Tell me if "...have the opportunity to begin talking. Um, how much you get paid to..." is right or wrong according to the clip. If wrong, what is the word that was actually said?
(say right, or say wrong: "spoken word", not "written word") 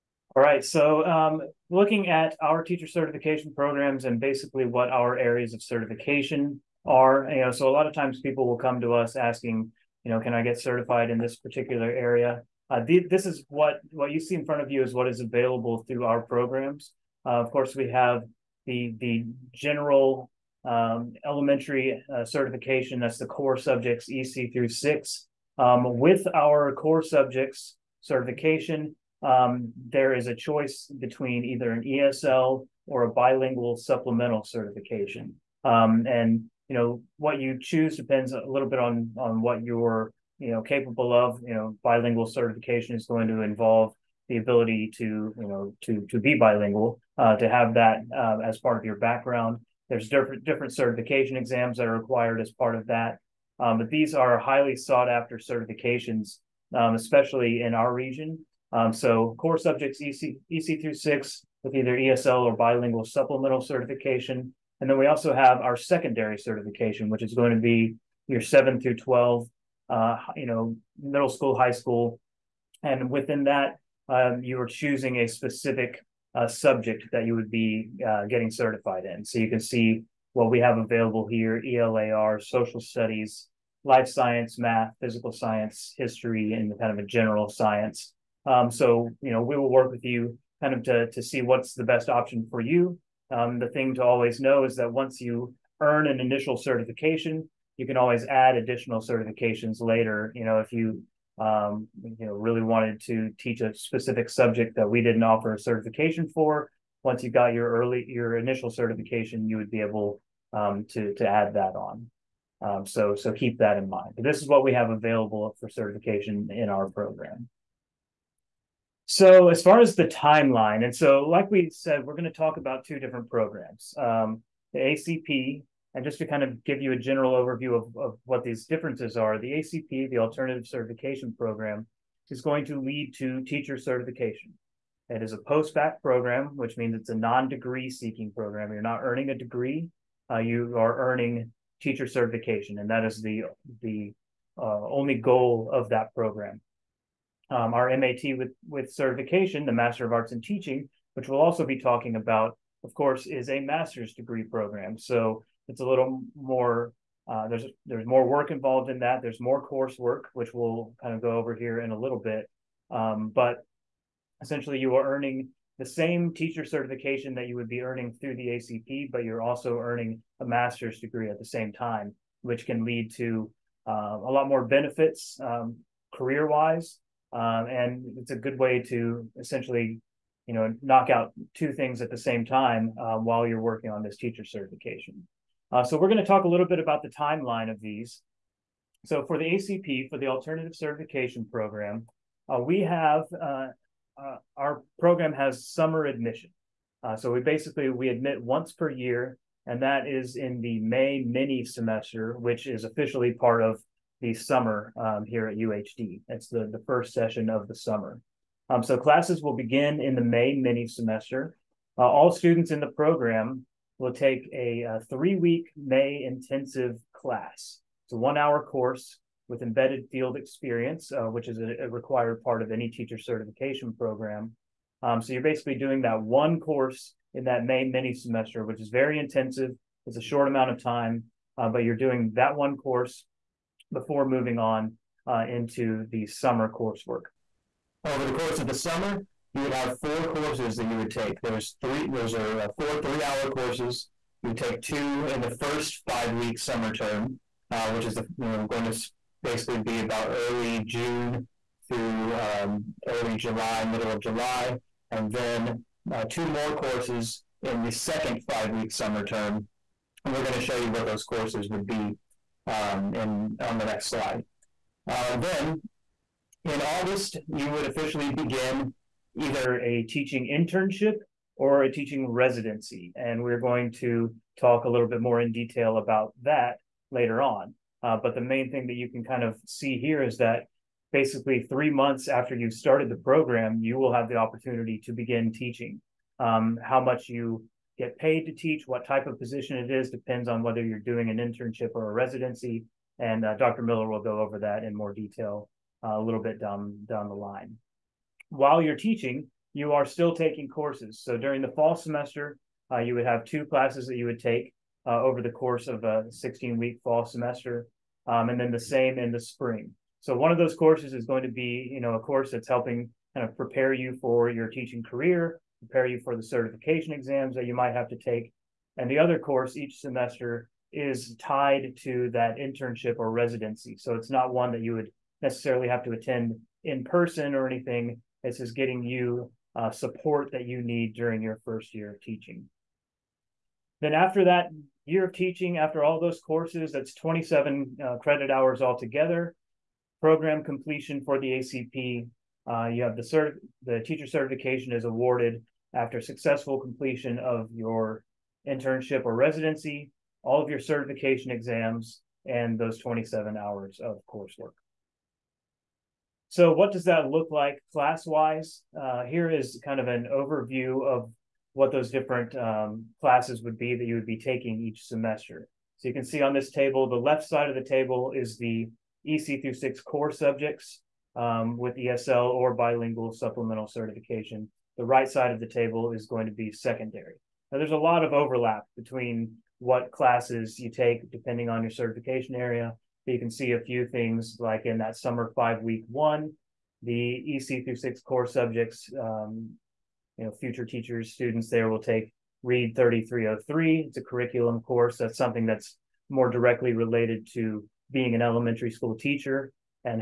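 wrong: "teaching", not "talking".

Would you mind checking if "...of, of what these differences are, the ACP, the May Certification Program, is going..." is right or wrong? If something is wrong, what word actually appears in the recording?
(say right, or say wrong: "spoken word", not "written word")
wrong: "Alternative", not "May".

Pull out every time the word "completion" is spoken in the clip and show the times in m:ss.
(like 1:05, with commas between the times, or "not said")
5:40, 5:46.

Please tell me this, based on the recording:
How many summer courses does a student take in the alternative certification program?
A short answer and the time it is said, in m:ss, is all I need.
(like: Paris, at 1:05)
4, at 3:59.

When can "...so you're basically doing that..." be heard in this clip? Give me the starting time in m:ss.
3:45.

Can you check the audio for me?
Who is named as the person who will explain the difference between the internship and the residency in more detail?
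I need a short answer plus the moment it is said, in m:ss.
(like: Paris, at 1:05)
Dr. Miller, at 4:53.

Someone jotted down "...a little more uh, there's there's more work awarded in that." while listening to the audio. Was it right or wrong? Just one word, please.
wrong.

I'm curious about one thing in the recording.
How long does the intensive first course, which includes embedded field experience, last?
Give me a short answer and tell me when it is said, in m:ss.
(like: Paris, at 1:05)
3 weeks, at 3:35.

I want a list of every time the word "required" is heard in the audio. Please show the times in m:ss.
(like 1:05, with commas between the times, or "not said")
0:51, 3:41.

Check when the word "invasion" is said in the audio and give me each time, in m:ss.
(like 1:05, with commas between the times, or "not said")
not said.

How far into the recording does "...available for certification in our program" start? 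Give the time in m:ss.
1:54.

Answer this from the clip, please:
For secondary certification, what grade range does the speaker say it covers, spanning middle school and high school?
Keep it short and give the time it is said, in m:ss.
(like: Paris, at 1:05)
7 through 12, at 1:08.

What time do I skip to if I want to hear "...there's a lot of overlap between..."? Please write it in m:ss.
6:17.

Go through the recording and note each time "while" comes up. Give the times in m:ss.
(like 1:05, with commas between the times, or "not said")
3:03, 4:58.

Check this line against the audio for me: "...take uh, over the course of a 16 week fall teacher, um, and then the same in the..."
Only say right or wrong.
wrong.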